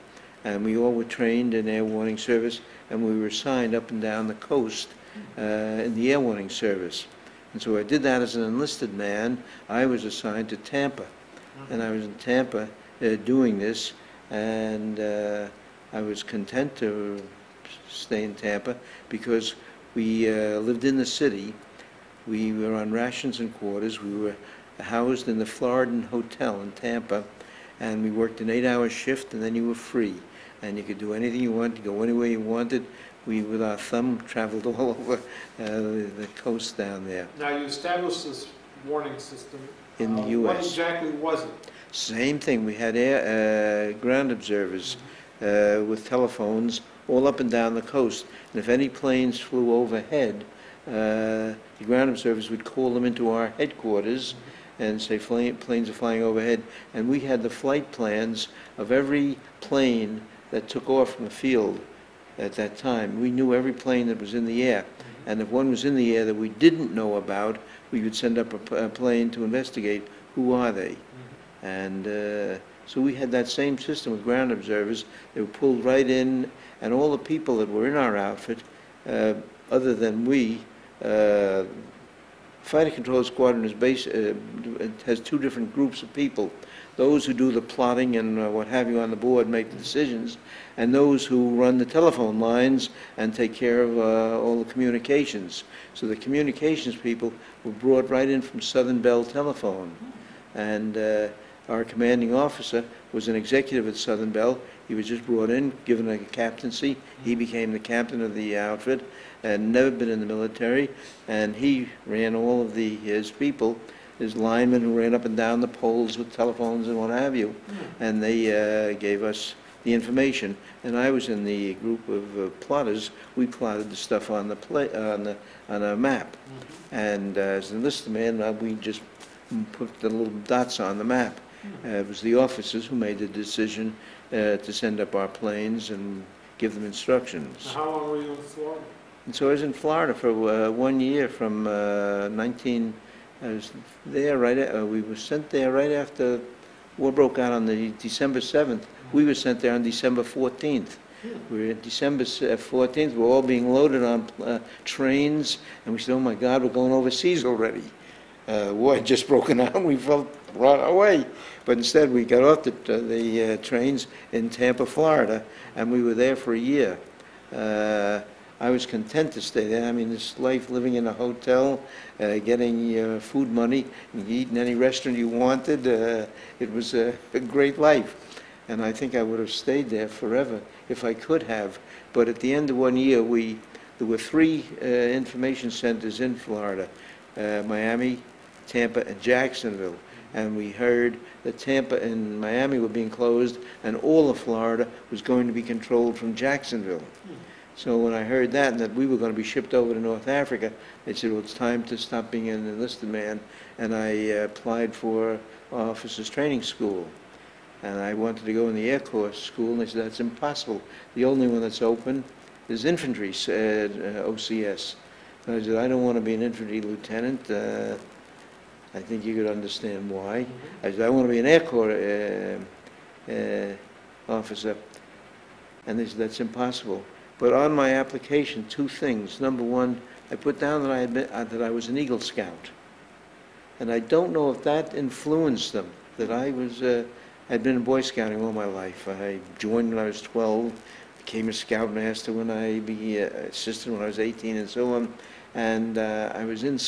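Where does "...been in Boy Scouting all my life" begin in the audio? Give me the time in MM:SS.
03:57.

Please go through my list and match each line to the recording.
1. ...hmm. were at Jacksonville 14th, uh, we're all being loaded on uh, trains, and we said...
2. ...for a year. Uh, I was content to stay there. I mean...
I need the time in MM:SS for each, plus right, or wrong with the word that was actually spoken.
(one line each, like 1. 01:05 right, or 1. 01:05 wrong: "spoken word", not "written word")
1. 02:31 wrong: "December", not "Jacksonville"
2. 02:46 right.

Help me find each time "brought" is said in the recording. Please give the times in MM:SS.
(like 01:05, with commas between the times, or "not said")
01:37, 01:45.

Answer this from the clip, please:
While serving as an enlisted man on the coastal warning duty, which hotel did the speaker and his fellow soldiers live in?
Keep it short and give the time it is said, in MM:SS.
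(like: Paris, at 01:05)
Floridan Hotel, at 00:25.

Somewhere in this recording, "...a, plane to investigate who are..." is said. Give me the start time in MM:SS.
01:08.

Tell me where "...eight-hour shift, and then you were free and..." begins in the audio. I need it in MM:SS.
00:28.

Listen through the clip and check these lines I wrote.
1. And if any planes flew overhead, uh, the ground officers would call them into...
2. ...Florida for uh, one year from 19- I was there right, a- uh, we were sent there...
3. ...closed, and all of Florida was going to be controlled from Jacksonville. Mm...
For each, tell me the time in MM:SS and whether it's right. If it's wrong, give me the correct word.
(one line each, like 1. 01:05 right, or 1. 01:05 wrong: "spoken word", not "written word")
1. 00:48 wrong: "observers", not "officers"
2. 02:19 right
3. 03:13 right.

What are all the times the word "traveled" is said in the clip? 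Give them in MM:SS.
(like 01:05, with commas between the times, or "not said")
00:34.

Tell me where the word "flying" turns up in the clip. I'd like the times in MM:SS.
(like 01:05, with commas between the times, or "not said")
00:55.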